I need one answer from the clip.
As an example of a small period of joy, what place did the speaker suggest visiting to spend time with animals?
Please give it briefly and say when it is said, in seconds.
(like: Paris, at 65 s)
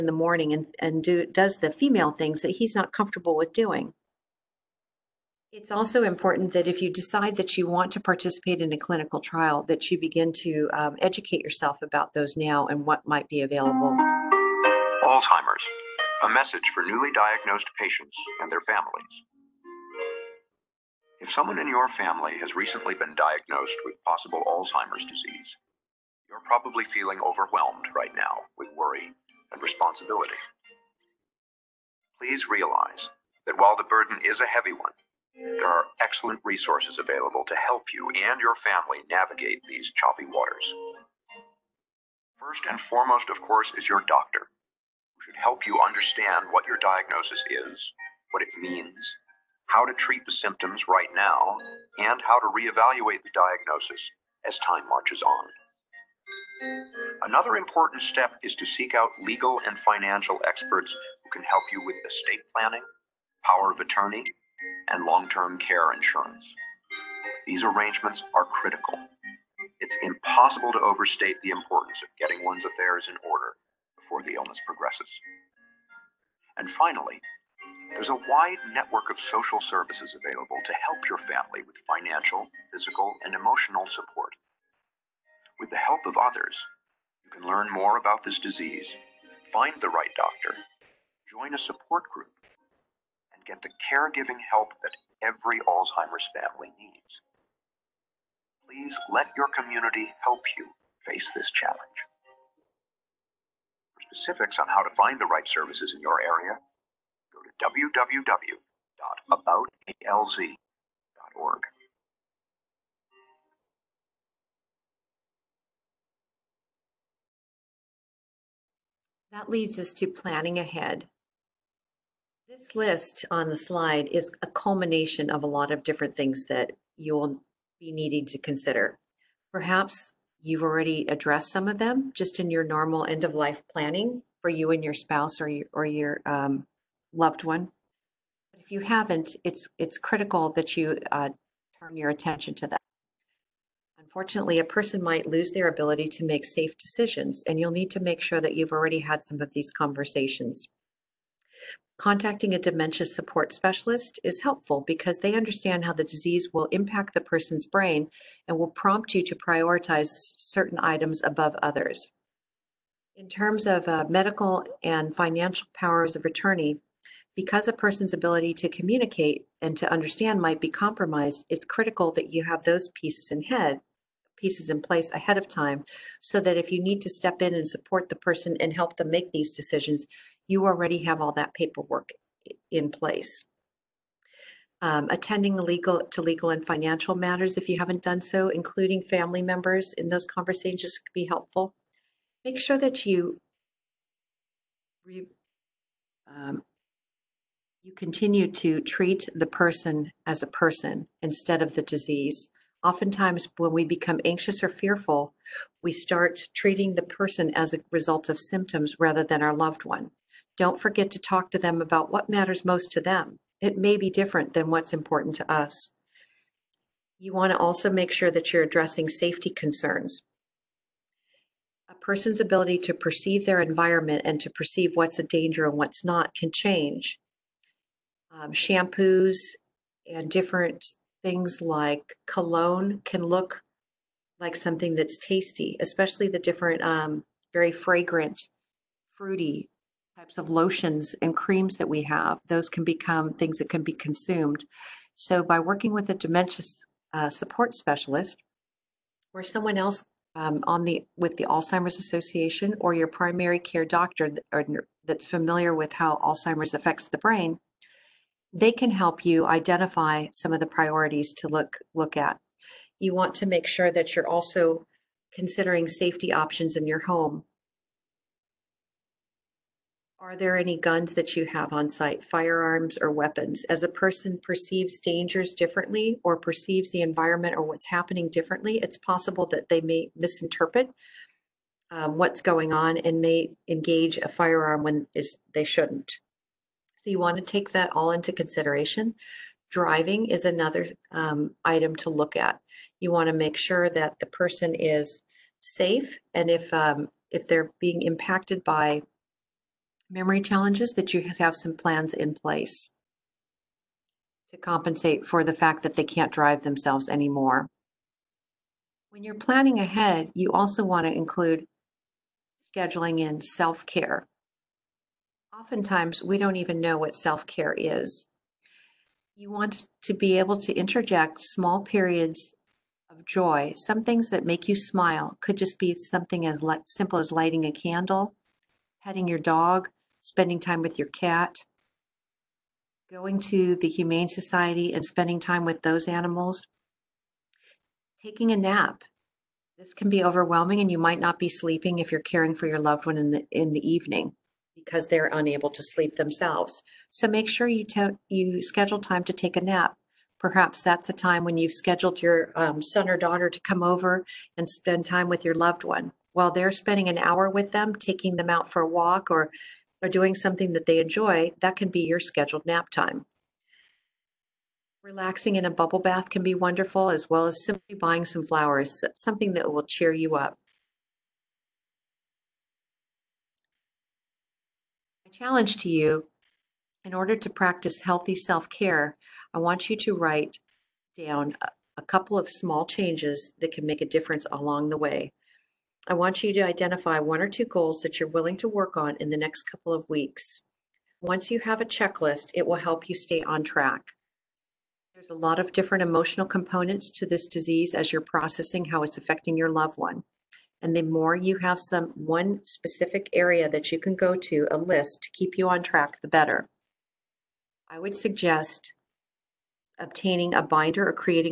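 Humane Society, at 333 s.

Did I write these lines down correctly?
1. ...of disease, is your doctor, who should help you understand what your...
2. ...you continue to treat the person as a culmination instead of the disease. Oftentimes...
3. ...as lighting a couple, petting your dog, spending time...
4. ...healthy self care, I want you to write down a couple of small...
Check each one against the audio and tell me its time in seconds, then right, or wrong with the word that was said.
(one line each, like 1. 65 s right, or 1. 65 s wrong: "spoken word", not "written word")
1. 43 s wrong: "course", not "disease"
2. 197 s wrong: "person", not "culmination"
3. 327 s wrong: "candle", not "couple"
4. 378 s right.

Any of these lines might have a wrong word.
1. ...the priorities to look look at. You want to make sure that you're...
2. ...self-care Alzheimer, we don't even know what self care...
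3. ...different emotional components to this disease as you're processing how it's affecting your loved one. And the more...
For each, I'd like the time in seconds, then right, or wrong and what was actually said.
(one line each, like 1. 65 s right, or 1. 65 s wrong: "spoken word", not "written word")
1. 260 s right
2. 313 s wrong: "Oftentimes", not "Alzheimer"
3. 395 s right.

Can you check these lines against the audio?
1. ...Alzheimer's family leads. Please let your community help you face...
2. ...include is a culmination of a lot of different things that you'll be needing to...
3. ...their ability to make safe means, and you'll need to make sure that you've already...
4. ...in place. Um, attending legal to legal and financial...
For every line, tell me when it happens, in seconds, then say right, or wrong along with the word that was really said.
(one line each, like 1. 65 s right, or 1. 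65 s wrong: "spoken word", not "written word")
1. 95 s wrong: "needs", not "leads"
2. 123 s wrong: "slide", not "include"
3. 145 s wrong: "decisions", not "means"
4. 182 s right.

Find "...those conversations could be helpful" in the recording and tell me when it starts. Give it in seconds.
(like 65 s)
190 s.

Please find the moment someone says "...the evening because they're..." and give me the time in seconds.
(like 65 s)
343 s.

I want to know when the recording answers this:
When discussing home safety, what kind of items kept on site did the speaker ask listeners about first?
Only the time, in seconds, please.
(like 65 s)
270 s.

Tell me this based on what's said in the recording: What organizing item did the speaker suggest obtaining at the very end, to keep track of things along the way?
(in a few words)
binder.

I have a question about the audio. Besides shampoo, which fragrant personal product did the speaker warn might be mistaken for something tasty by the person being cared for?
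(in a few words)
cologne.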